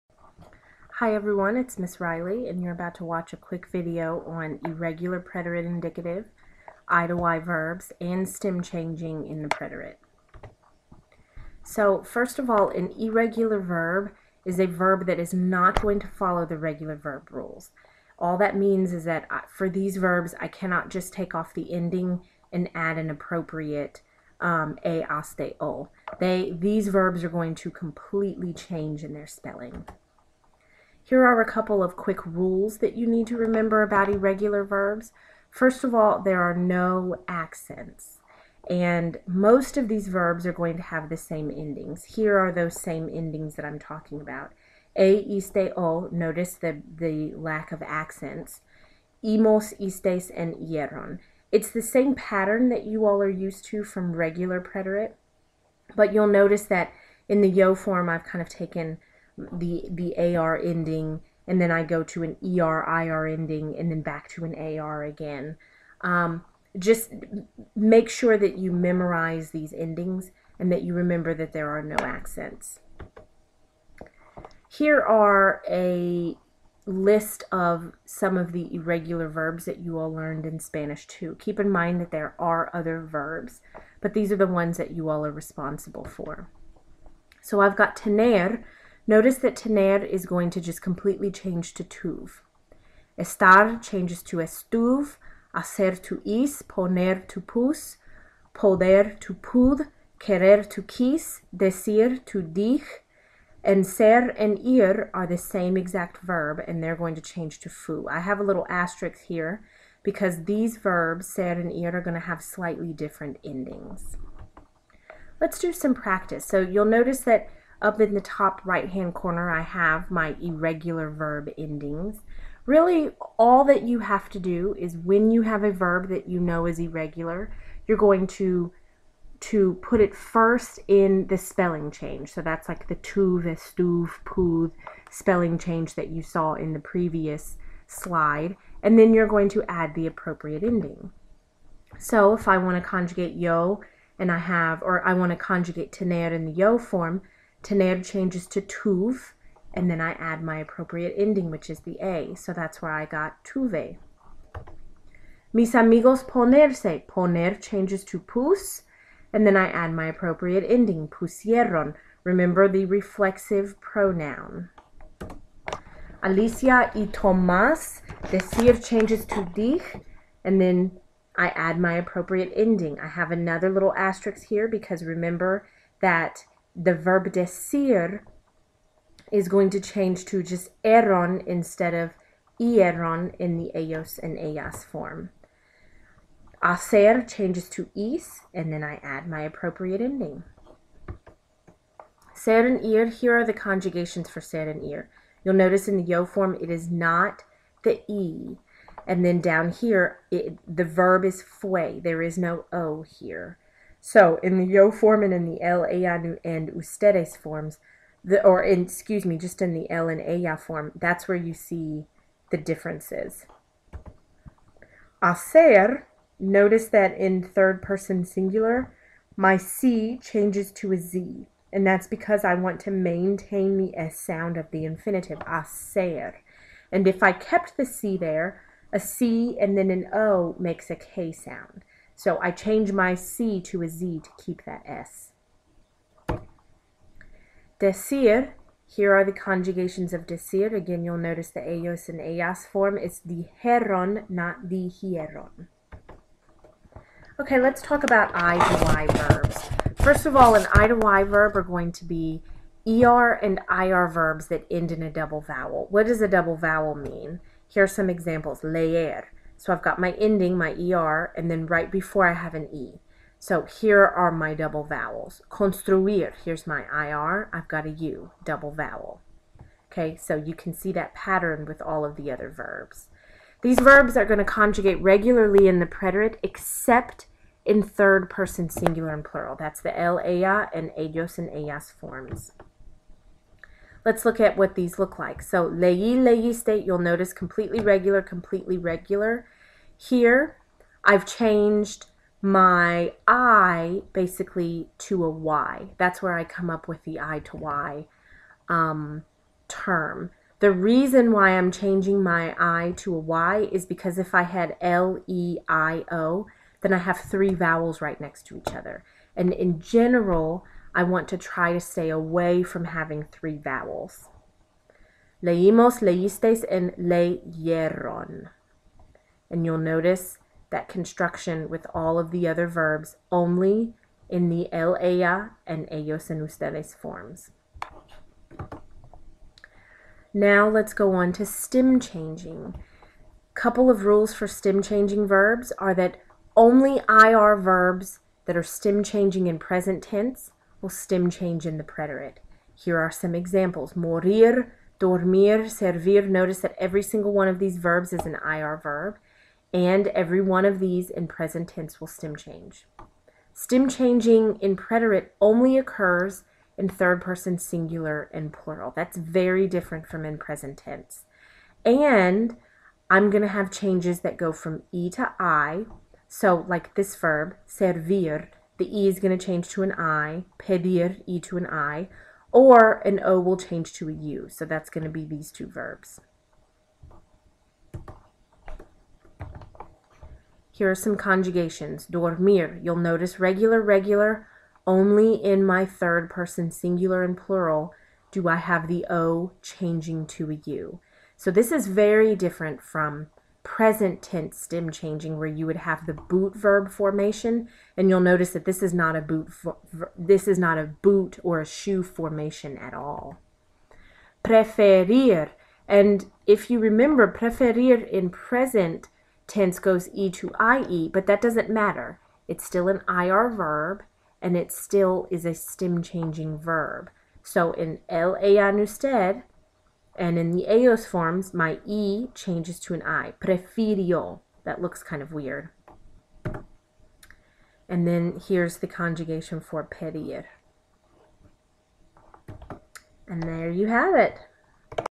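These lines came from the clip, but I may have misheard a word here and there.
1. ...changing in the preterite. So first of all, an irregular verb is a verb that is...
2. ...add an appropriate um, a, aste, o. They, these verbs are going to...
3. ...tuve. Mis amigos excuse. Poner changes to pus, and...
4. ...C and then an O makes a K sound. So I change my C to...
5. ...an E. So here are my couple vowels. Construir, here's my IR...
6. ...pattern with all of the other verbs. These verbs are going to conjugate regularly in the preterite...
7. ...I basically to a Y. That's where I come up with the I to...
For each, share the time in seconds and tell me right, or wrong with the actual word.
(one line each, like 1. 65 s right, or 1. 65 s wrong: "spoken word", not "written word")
1. 8 s right
2. 22 s right
3. 153 s wrong: "ponerse", not "excuse"
4. 228 s right
5. 262 s wrong: "double", not "couple"
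6. 271 s right
7. 293 s right.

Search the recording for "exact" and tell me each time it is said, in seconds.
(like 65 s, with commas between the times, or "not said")
105 s.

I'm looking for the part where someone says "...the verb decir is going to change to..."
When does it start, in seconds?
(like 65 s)
176 s.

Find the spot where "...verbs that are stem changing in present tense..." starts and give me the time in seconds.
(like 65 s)
337 s.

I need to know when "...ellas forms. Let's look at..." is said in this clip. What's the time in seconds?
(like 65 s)
281 s.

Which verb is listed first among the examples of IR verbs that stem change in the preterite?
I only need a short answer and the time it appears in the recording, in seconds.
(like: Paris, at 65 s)
morir, at 343 s.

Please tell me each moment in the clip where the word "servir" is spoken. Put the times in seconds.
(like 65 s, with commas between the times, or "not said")
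345 s, 367 s.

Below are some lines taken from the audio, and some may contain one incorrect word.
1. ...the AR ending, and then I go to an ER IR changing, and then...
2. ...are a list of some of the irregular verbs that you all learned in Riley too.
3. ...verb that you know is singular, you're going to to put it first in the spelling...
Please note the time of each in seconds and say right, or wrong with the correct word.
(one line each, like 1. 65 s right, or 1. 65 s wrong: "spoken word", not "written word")
1. 59 s wrong: "ending", not "changing"
2. 75 s wrong: "Spanish", not "Riley"
3. 125 s wrong: "irregular", not "singular".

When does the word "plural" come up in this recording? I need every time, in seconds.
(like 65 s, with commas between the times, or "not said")
279 s, 358 s, 387 s.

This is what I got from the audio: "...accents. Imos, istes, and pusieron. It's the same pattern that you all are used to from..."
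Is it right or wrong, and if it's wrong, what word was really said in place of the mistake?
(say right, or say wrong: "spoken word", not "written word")
wrong: "ieron", not "pusieron".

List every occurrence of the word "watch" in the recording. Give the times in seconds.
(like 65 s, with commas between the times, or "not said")
3 s.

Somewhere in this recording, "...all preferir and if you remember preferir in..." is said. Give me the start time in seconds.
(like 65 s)
402 s.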